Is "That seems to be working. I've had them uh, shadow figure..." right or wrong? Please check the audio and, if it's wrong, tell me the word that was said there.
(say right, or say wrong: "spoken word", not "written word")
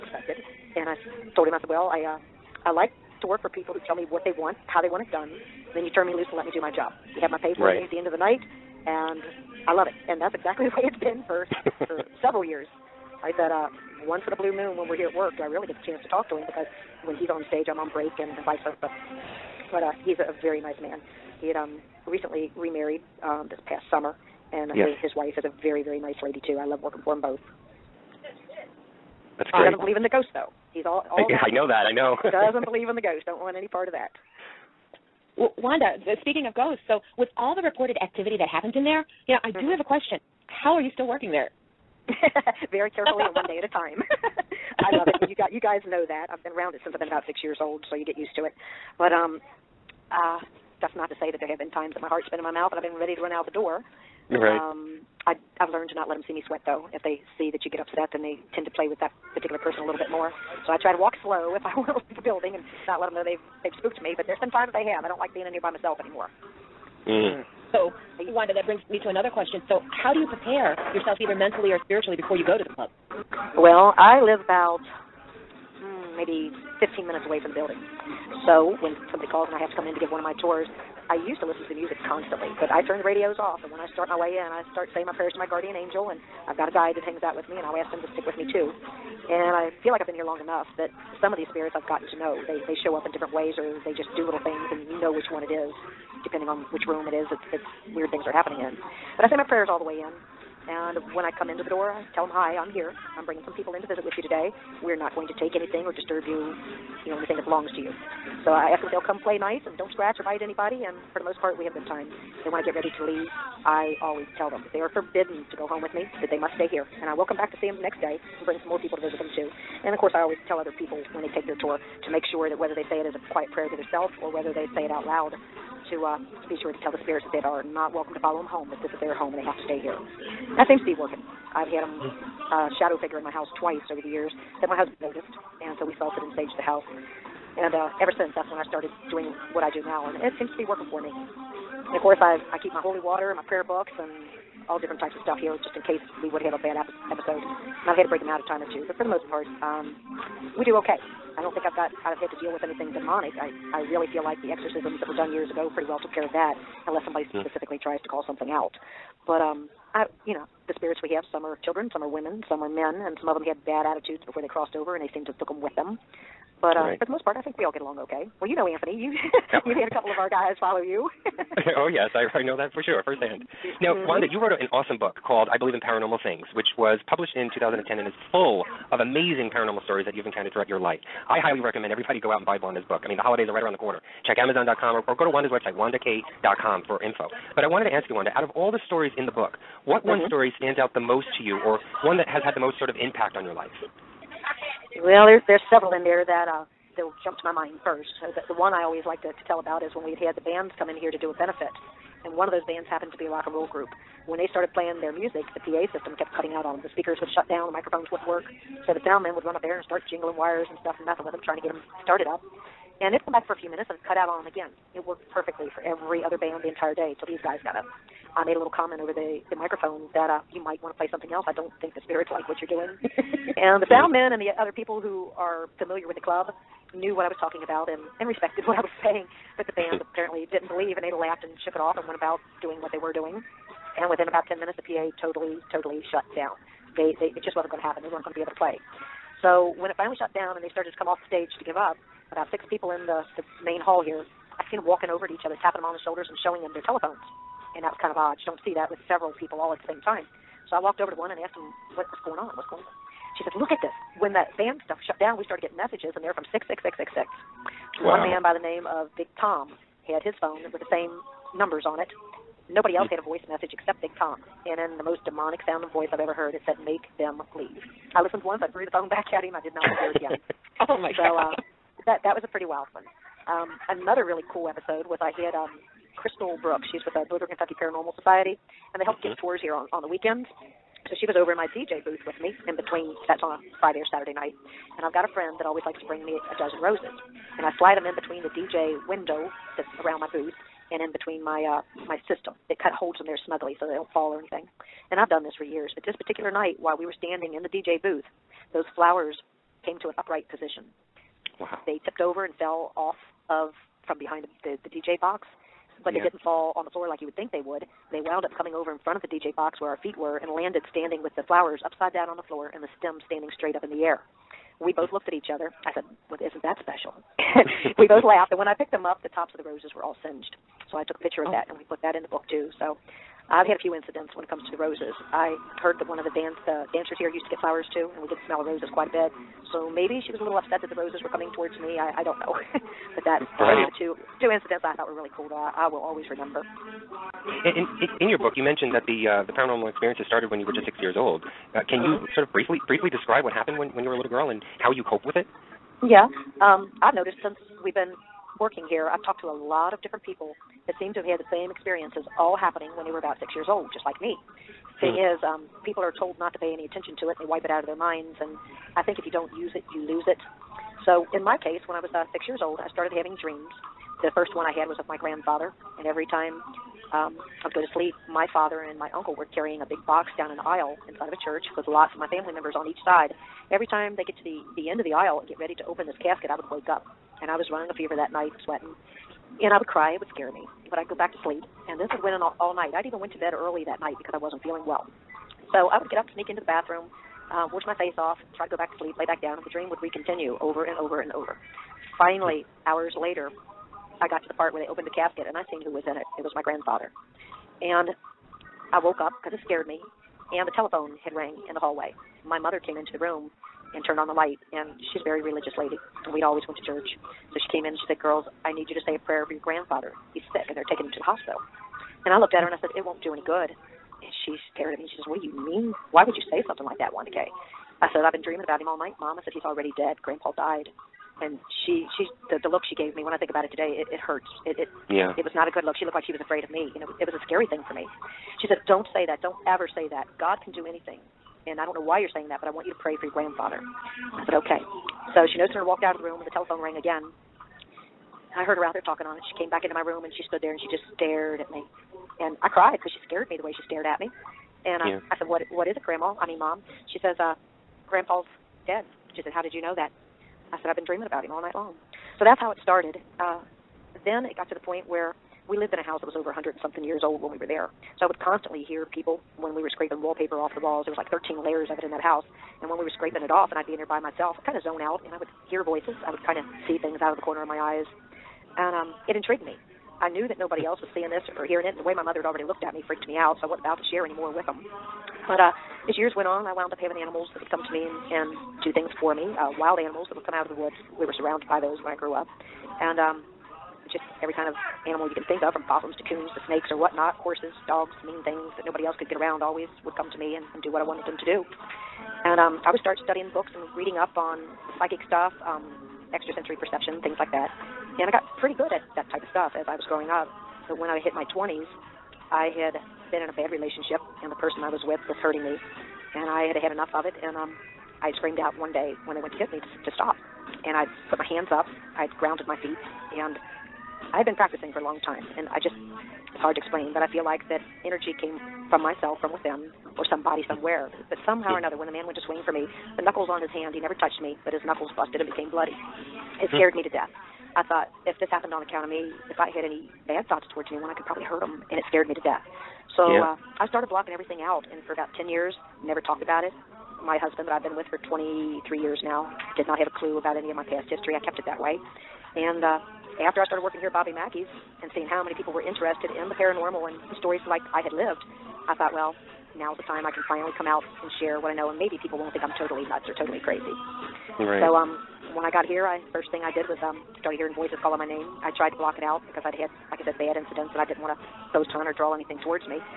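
right.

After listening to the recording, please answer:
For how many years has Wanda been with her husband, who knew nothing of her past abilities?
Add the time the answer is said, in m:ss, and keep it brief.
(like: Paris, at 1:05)
23, at 8:58.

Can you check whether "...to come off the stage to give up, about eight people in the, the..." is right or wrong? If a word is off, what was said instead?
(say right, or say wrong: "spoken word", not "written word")
wrong: "six", not "eight".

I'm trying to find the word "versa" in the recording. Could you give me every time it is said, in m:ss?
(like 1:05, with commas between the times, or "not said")
0:18.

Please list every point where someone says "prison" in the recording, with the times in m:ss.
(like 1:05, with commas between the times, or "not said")
not said.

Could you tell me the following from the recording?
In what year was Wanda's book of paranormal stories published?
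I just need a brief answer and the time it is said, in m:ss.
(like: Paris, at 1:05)
2010, at 2:57.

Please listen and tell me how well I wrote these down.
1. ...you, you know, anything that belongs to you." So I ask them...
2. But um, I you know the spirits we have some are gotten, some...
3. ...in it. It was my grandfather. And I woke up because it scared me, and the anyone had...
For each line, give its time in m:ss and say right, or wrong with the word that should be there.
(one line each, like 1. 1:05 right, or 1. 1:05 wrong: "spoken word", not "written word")
1. 1:46 right
2. 2:39 wrong: "children", not "gotten"
3. 6:36 wrong: "telephone", not "anyone".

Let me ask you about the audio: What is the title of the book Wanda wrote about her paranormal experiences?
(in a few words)
I Believe in Paranormal Things.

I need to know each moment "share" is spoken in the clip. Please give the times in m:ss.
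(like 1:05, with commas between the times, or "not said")
7:54, 9:11.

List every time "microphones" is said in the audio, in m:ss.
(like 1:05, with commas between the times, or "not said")
3:27, 3:39.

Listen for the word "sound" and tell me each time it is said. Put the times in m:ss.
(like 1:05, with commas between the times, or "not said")
3:29, 3:43, 4:25.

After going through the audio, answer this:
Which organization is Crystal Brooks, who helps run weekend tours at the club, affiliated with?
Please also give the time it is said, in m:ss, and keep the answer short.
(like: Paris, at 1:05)
Northern Kentucky Paranormal Society, at 4:37.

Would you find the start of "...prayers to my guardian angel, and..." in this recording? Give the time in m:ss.
1:25.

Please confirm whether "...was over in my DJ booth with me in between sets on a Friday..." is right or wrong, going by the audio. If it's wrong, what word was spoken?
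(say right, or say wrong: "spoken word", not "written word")
right.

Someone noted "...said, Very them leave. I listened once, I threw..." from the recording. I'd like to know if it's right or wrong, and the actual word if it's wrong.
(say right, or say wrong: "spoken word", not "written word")
wrong: "Make", not "Very".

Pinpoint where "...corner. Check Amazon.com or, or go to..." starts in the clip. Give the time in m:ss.
3:03.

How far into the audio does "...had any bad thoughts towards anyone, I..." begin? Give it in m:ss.
8:49.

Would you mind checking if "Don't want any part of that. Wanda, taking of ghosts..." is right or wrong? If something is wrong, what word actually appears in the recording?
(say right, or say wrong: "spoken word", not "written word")
wrong: "speaking", not "taking".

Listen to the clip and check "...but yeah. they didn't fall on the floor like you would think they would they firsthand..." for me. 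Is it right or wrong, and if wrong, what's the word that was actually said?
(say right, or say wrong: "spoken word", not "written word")
wrong: "wound", not "firsthand".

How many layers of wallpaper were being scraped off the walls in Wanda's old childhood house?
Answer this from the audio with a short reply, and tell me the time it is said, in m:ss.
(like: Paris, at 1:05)
13, at 7:41.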